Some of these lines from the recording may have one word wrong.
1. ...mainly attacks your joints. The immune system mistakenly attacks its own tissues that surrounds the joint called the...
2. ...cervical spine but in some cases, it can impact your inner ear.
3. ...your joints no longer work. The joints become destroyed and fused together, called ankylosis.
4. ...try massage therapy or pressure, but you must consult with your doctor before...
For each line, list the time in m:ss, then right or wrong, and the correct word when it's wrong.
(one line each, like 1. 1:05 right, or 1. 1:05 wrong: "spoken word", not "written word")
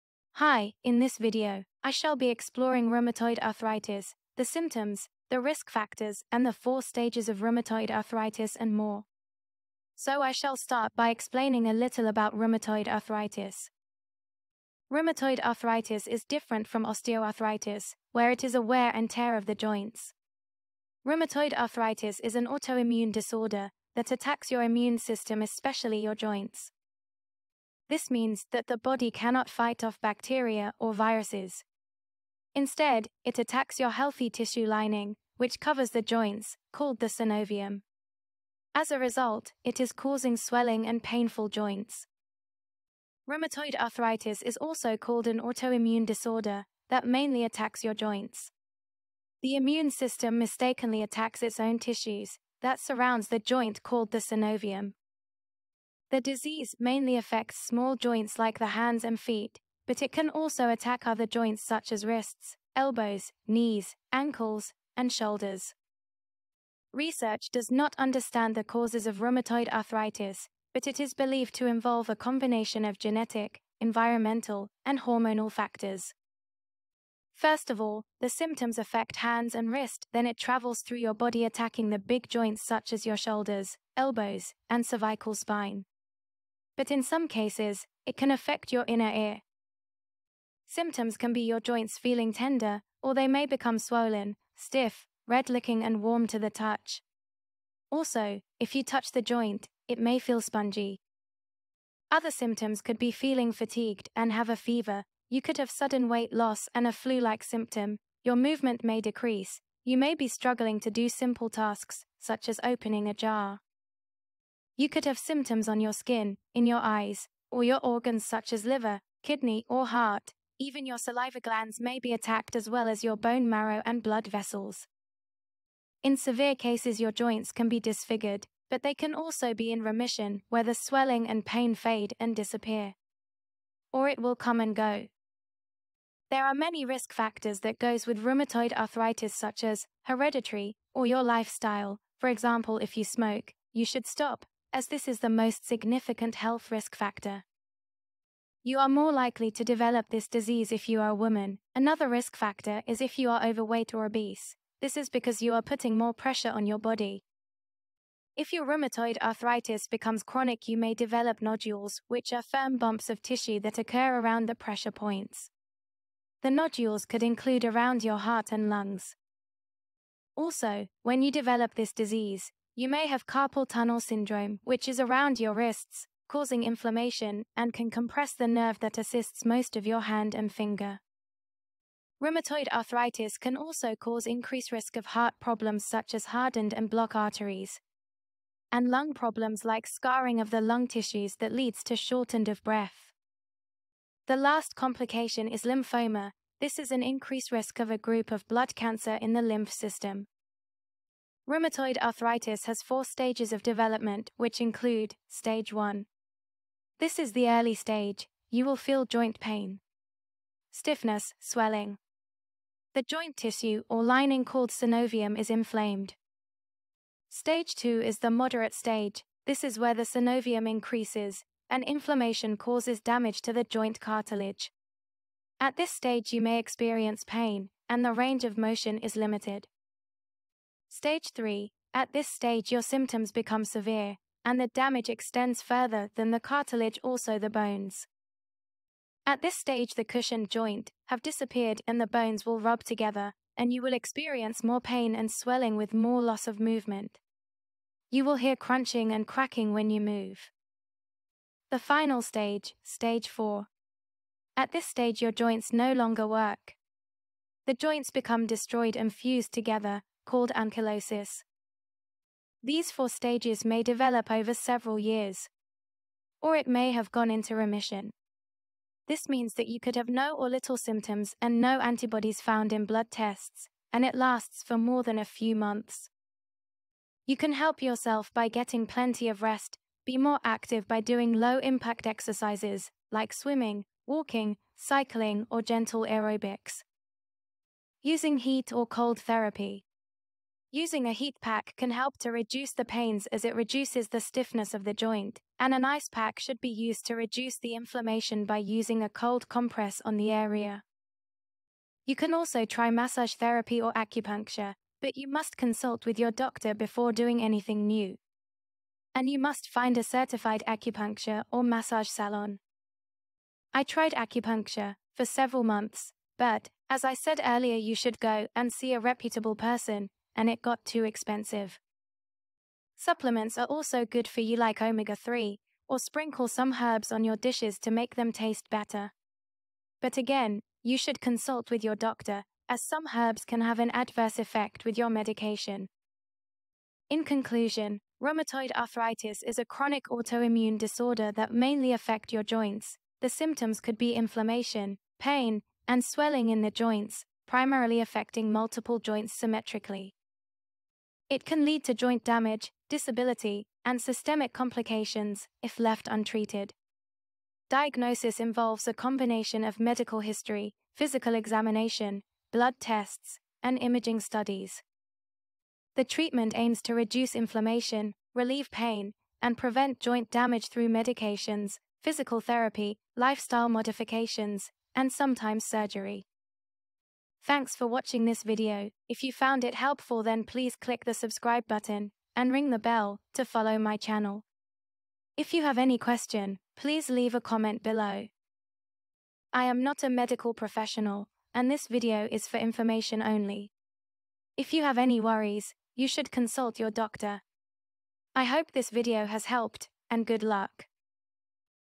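1. 0:47 right
2. 1:24 wrong: "affect", not "impact"
3. 4:15 right
4. 5:02 wrong: "acupuncture", not "pressure".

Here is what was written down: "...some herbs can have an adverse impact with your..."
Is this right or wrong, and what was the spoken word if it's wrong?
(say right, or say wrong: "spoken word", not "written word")
wrong: "effect", not "impact".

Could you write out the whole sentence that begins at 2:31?
Another risk factor is if you are overweight or obese.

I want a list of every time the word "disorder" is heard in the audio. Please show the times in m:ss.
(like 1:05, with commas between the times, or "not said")
0:23, 0:46, 5:40.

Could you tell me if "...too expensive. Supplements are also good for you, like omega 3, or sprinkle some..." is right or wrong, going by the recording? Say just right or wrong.
right.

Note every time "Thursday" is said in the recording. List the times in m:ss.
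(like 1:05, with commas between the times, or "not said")
not said.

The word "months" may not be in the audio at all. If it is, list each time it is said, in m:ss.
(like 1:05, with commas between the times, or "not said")
4:35, 5:15.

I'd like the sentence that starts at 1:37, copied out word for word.
Also, if you touch the joint, it may feel spongy.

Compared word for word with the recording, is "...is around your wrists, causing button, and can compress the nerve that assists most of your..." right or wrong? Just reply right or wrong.
wrong.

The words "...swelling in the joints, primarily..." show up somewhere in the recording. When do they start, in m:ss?
5:46.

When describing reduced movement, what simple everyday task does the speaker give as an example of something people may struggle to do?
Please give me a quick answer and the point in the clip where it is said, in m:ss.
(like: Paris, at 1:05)
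Opening a jar, at 1:52.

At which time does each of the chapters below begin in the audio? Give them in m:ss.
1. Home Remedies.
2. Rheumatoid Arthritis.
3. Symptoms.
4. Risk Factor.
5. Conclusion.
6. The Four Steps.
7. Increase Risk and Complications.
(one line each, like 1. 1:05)
1. 4:41
2. 0:47
3. 1:26
4. 2:20
5. 5:41
6. 3:23
7. 2:43.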